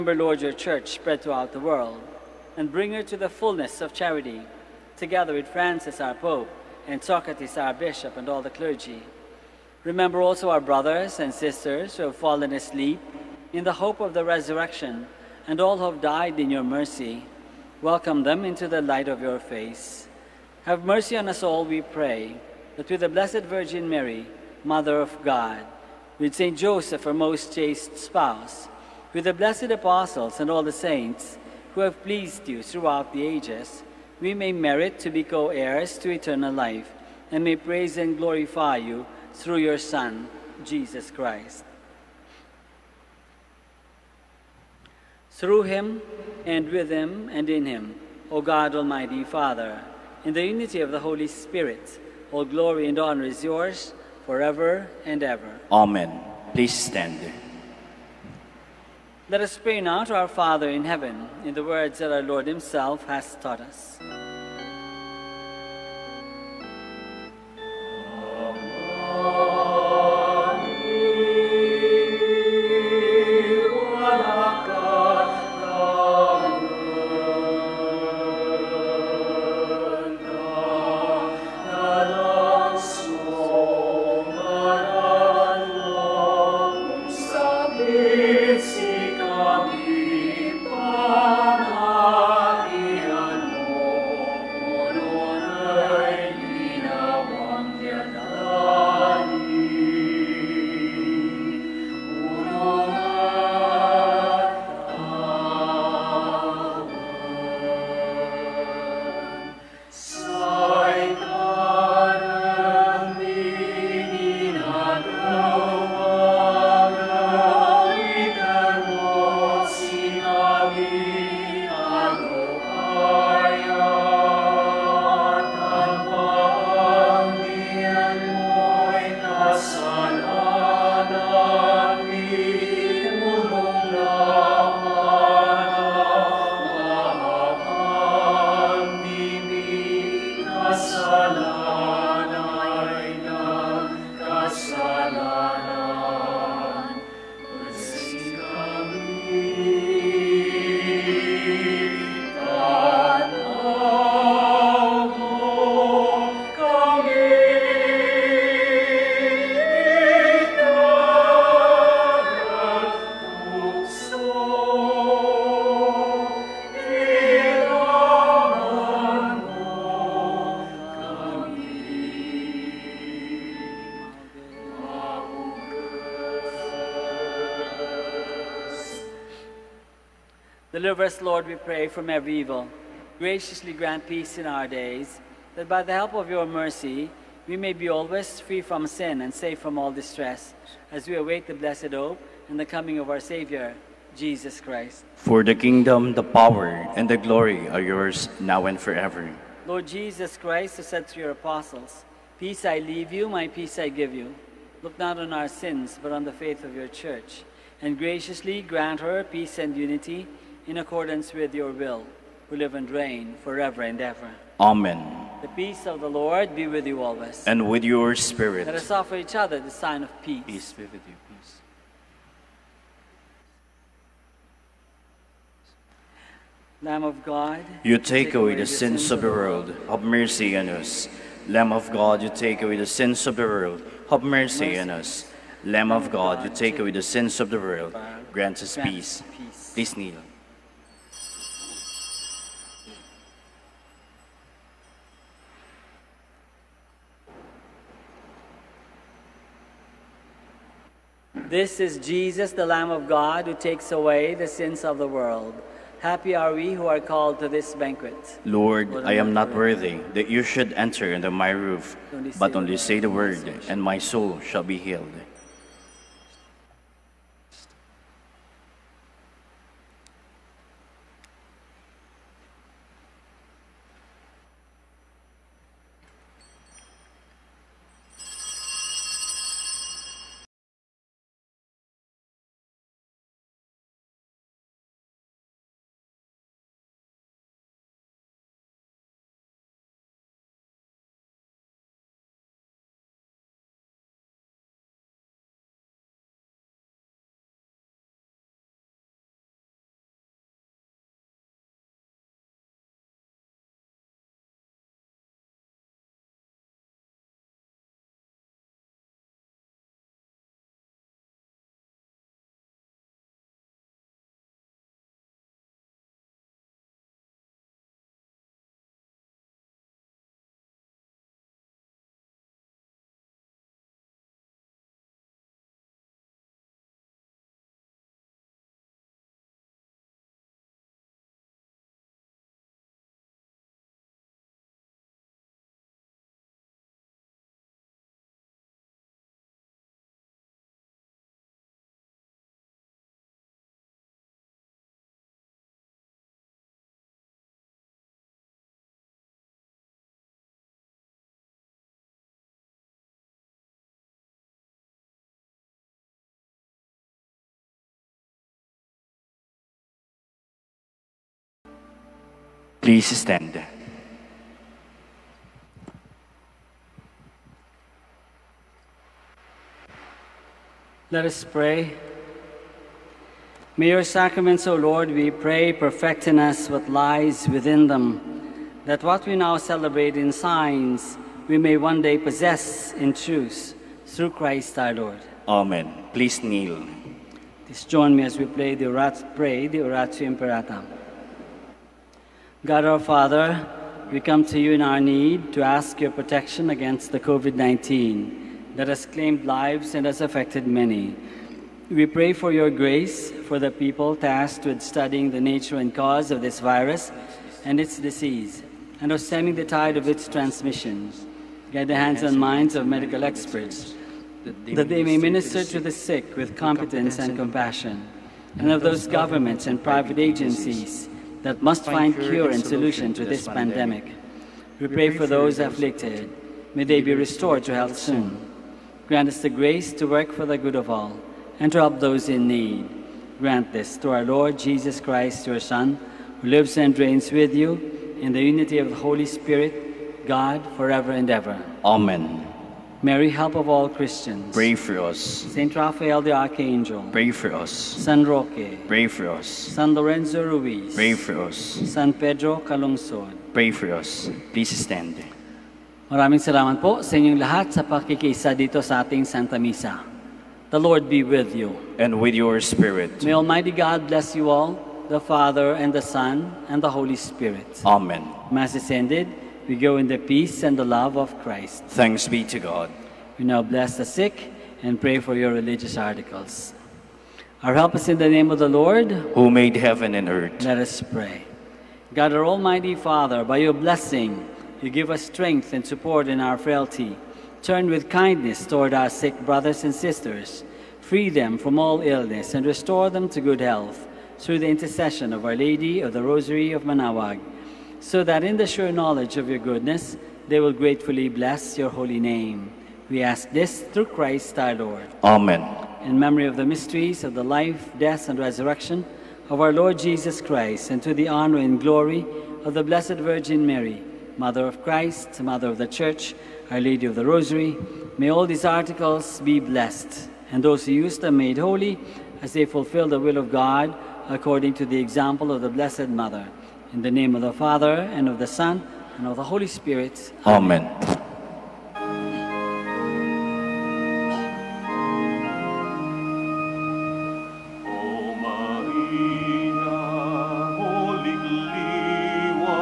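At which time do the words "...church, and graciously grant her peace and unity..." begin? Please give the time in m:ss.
3:27.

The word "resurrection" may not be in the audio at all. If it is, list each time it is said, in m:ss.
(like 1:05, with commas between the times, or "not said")
0:14, 8:28.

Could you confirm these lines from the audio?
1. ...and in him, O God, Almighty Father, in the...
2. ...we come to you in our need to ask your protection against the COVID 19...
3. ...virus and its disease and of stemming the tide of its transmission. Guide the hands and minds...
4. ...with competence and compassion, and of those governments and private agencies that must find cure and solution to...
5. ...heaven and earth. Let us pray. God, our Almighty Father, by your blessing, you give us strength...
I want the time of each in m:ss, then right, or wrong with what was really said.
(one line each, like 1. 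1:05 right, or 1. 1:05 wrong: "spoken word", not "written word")
1. 0:47 right
2. 6:34 right
3. 6:46 right
4. 6:56 right
5. 7:59 right.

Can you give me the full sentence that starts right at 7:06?
May they be restored to health soon.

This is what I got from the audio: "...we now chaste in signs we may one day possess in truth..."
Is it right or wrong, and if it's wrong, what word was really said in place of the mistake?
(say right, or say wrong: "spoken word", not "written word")
wrong: "celebrate", not "chaste".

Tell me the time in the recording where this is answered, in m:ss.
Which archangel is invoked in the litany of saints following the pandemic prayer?
7:25.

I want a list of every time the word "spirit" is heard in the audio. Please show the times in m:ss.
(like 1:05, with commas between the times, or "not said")
0:51, 3:38, 7:19, 7:42, 7:47, 8:49.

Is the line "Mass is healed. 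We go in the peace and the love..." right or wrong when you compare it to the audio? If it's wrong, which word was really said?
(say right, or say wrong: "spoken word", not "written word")
wrong: "ended", not "healed".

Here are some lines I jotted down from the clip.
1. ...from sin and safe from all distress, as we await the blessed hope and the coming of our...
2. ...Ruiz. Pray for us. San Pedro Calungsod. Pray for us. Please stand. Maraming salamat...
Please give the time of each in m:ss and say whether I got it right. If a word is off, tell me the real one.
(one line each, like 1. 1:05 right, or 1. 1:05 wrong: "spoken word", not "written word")
1. 3:08 right
2. 7:30 right.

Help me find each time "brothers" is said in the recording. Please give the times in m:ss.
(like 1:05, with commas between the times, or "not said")
0:10, 8:09.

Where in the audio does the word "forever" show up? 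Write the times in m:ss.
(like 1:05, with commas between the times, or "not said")
0:54, 3:18, 3:33, 7:20.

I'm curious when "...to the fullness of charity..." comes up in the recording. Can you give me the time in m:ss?
0:03.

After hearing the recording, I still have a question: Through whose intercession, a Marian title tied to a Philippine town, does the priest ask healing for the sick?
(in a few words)
Our Lady of the Rosary of Manaoag.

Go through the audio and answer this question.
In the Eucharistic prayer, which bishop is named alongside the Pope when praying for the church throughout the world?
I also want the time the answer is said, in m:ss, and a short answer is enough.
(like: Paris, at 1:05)
Socrates, at 0:07.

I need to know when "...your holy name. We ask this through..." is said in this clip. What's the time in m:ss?
8:21.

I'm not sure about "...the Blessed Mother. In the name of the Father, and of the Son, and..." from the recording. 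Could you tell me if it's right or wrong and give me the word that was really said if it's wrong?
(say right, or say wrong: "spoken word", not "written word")
right.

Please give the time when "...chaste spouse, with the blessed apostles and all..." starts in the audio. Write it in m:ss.
0:27.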